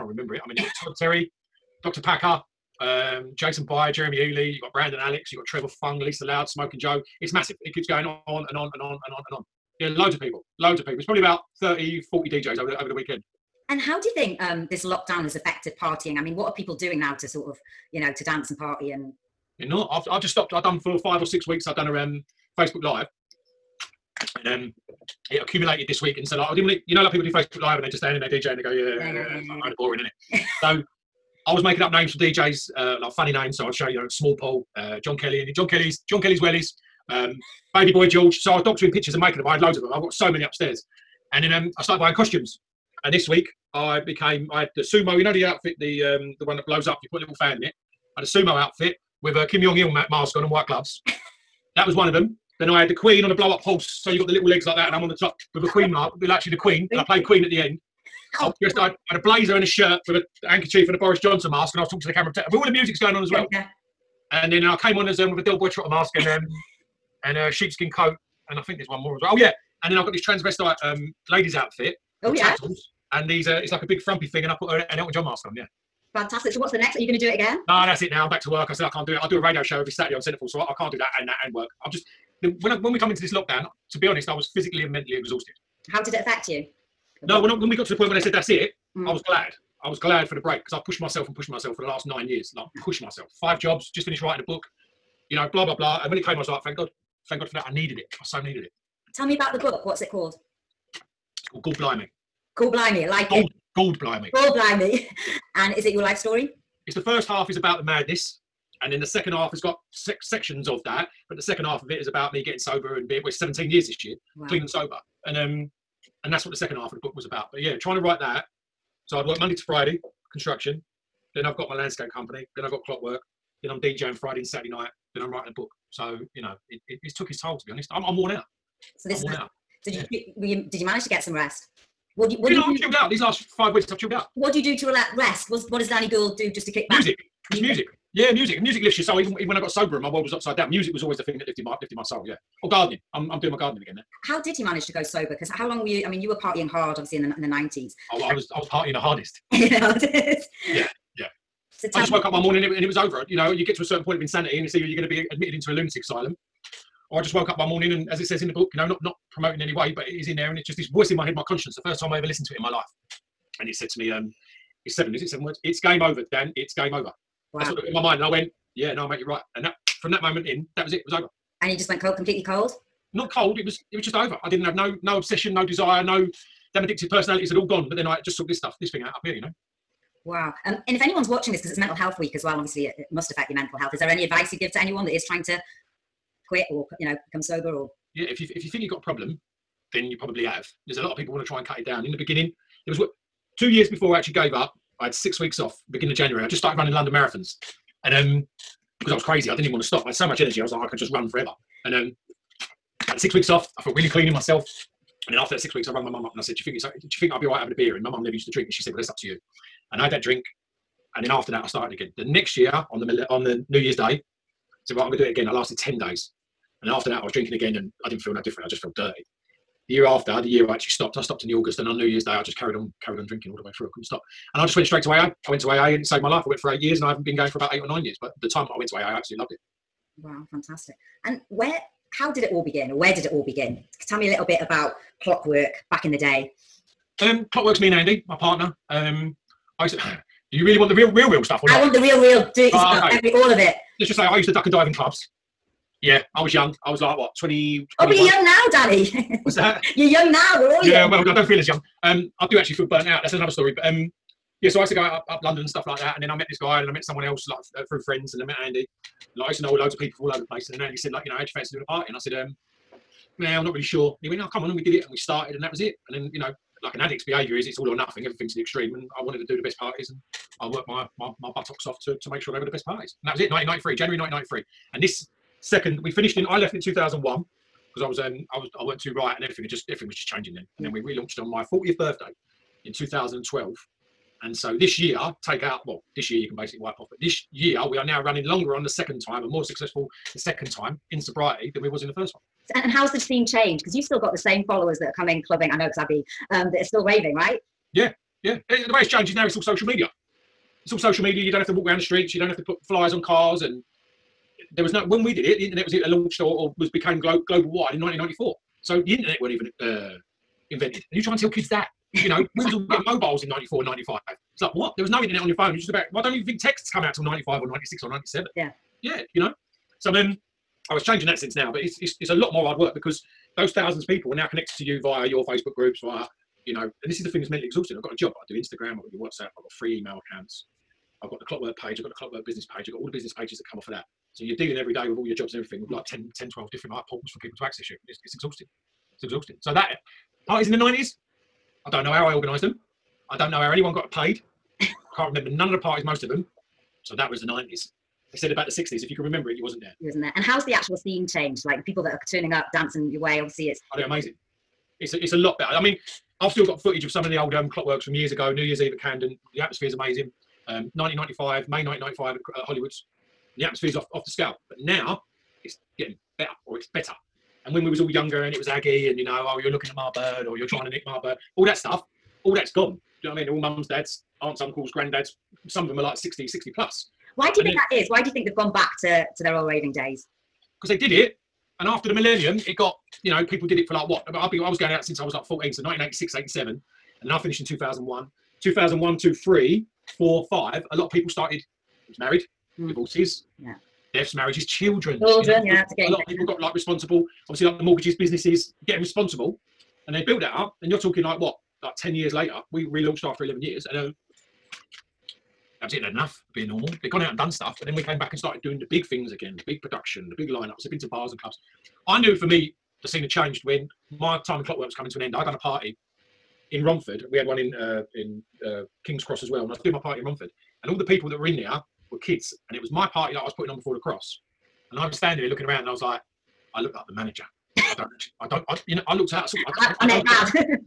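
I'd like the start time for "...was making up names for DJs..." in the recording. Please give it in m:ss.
0:31.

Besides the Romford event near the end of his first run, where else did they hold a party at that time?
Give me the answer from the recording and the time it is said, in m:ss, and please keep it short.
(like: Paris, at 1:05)
King's Cross, at 6:59.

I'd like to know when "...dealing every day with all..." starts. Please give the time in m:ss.
5:34.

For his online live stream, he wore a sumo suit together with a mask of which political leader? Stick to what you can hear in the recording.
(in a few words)
Kim Jong Il.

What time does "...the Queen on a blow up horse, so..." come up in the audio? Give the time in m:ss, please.
0:52.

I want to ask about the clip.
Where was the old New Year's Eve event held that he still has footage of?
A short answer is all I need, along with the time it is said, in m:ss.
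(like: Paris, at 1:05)
Camden, at 5:58.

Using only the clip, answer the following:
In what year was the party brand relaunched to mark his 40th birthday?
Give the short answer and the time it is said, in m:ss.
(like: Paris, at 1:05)
2012, at 4:42.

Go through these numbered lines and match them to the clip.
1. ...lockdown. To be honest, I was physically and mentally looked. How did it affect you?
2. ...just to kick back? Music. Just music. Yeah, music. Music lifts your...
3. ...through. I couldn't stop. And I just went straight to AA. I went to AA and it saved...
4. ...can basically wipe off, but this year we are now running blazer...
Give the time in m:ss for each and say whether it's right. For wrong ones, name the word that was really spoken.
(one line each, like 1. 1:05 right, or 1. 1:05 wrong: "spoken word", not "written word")
1. 1:23 wrong: "exhausted", not "looked"
2. 2:16 right
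3. 3:43 right
4. 4:46 wrong: "longer", not "blazer".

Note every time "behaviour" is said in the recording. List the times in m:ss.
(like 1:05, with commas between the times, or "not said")
4:27.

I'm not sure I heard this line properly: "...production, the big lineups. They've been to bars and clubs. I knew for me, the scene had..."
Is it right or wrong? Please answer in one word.
right.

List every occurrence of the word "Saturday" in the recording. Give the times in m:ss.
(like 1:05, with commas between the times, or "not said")
1:19, 2:04.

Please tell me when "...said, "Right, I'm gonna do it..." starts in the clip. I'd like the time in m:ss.
3:34.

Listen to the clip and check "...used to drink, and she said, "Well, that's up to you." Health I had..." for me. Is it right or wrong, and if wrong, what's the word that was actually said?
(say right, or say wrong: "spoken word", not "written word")
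wrong: "And", not "Health".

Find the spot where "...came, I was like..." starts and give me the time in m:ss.
1:36.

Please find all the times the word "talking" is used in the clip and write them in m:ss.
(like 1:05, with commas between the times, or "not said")
1:01, 6:40.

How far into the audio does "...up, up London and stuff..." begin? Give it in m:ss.
4:15.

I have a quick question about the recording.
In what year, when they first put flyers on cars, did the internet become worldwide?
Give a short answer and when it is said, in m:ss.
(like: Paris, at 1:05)
1994, at 5:08.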